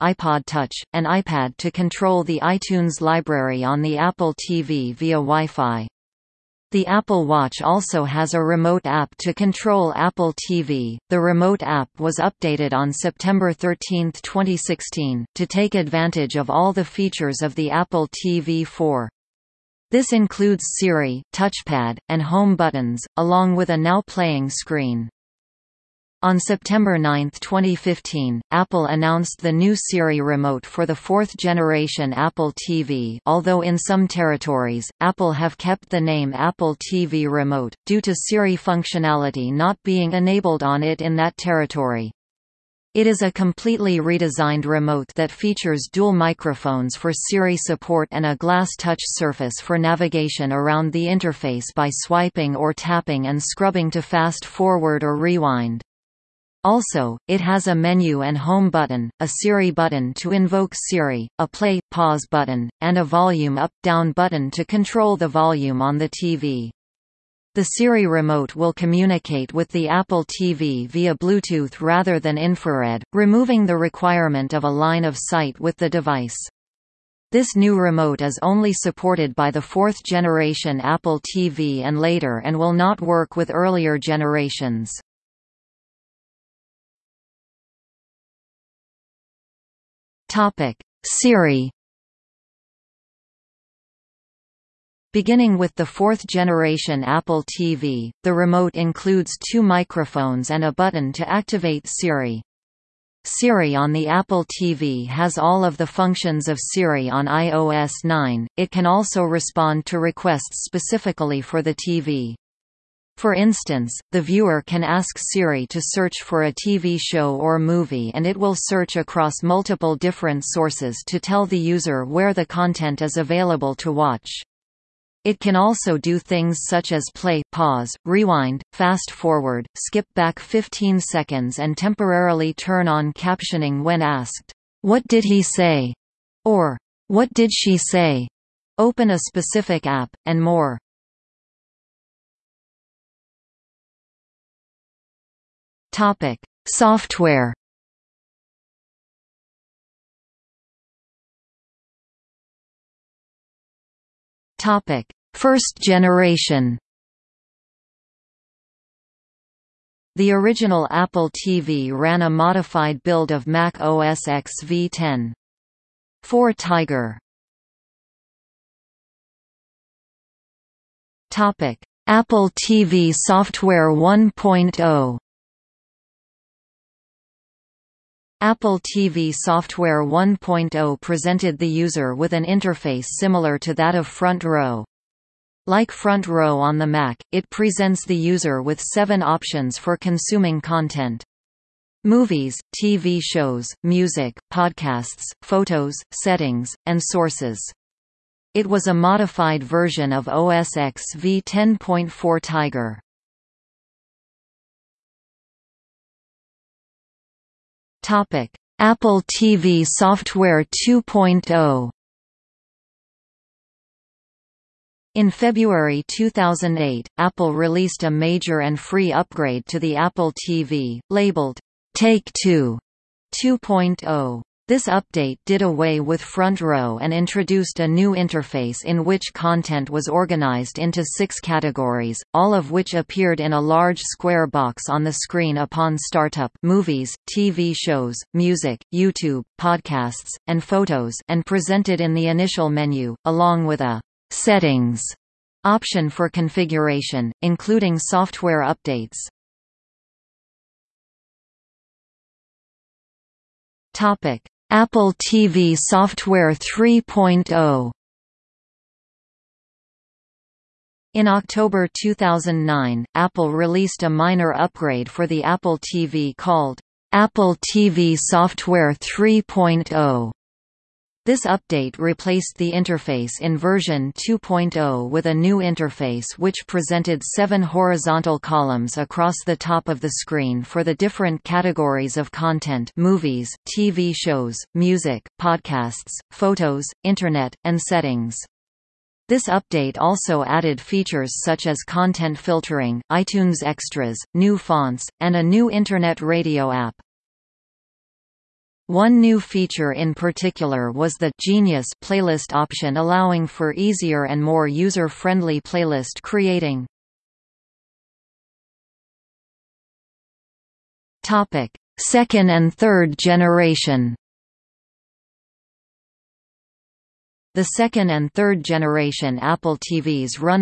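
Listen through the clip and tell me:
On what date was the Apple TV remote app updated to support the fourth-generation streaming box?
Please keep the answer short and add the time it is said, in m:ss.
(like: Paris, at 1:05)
September 13, 2016, at 0:12.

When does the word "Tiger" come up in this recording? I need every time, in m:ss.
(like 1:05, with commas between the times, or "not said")
2:46, 3:22.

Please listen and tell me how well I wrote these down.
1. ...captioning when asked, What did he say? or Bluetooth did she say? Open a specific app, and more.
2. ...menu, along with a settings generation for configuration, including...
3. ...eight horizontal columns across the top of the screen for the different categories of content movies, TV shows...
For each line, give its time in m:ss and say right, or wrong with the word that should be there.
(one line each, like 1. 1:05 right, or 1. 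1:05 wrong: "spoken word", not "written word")
1. 2:13 wrong: "What", not "Bluetooth"
2. 4:02 wrong: "option", not "generation"
3. 4:37 wrong: "seven", not "eight".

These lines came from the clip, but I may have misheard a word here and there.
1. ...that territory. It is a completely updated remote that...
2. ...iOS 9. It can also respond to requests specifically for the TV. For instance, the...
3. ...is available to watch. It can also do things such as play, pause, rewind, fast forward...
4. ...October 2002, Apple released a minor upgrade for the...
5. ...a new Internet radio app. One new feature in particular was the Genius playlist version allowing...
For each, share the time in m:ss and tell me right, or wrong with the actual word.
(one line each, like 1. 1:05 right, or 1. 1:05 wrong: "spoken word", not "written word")
1. 0:41 wrong: "redesigned", not "updated"
2. 1:47 right
3. 2:03 right
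4. 4:21 wrong: "2009", not "2002"
5. 4:55 wrong: "option", not "version".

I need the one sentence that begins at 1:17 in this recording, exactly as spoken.
This new remote is only supported by the fourth generation Apple TV and later and will not work with earlier generations.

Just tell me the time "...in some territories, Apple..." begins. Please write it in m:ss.
0:33.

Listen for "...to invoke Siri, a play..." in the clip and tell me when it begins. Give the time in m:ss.
1:00.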